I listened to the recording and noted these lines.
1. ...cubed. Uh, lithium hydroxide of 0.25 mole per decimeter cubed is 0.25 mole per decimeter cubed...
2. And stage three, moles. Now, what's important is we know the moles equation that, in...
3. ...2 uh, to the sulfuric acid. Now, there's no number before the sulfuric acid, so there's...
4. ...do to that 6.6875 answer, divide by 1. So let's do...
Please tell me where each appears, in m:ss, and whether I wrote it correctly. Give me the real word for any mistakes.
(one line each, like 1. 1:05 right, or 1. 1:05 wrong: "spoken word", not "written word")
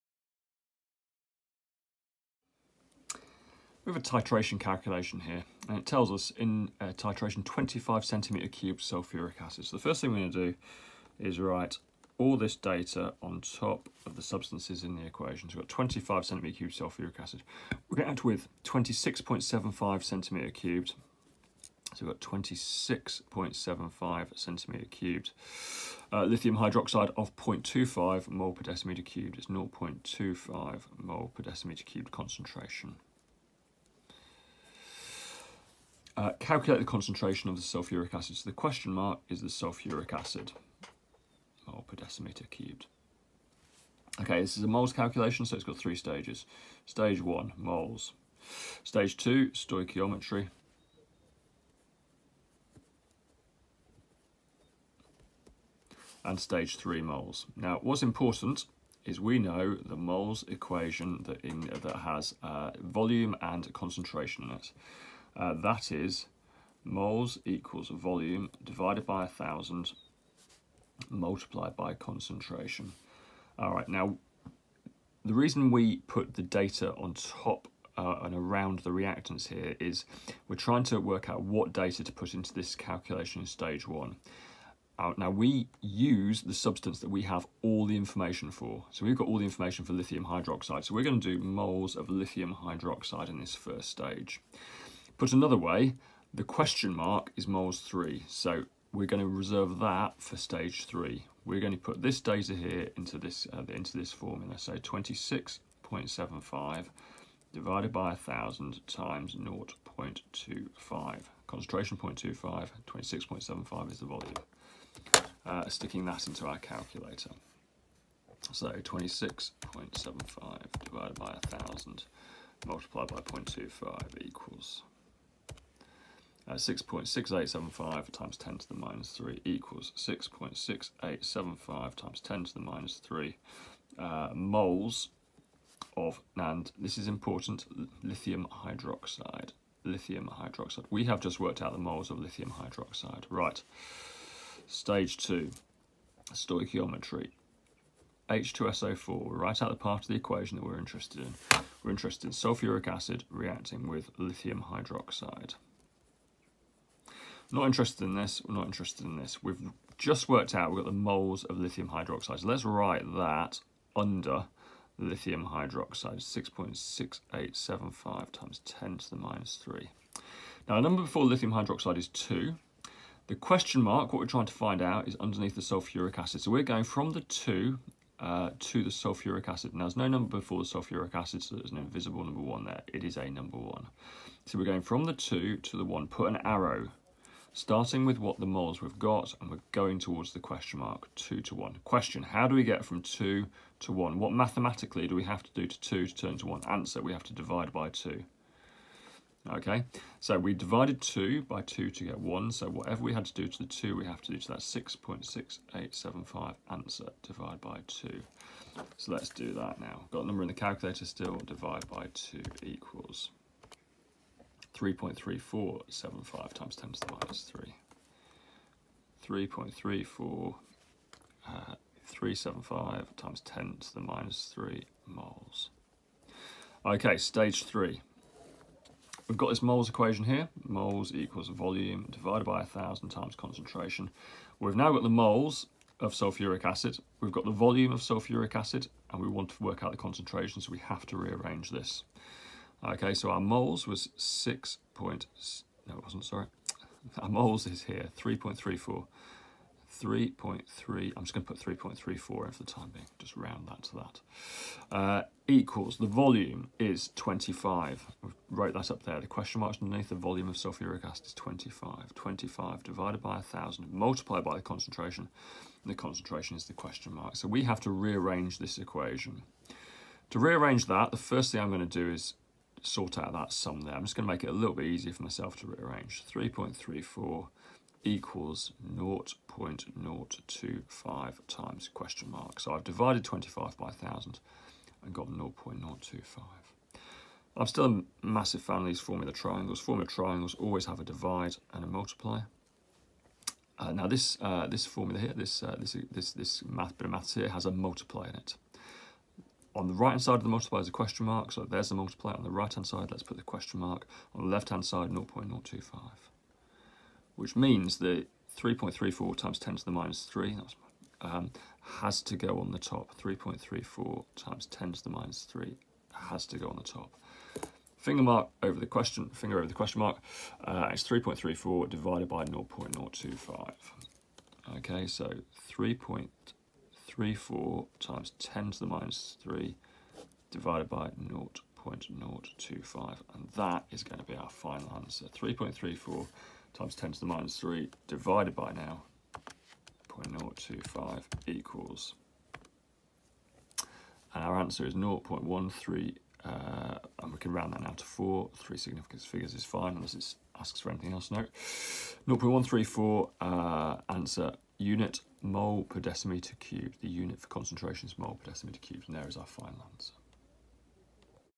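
1. 0:24 right
2. 0:56 right
3. 2:57 right
4. 3:24 wrong: "2", not "1".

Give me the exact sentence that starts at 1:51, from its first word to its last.
Concentration 0.25, 26.75 is the volume.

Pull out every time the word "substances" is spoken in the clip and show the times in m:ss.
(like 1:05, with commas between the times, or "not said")
0:14, 1:26.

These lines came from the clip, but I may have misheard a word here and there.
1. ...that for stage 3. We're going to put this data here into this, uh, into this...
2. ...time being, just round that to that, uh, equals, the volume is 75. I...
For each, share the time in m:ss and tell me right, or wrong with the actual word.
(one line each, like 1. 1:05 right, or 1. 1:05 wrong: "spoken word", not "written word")
1. 1:39 right
2. 4:12 wrong: "25", not "75".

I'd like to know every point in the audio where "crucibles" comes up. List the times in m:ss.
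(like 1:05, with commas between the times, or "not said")
not said.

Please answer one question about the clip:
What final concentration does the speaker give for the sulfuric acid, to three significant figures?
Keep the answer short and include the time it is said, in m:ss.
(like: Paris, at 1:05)
0.134 mol/dm³, at 5:52.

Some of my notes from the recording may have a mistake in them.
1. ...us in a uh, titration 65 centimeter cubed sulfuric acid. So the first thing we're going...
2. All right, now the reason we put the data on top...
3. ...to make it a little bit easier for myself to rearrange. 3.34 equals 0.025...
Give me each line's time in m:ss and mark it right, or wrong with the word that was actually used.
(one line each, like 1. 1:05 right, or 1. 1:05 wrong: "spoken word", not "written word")
1. 0:06 wrong: "25", not "65"
2. 1:13 right
3. 4:34 right.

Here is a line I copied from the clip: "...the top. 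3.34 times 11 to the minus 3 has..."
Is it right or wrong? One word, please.
wrong.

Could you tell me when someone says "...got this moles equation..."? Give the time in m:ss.
3:49.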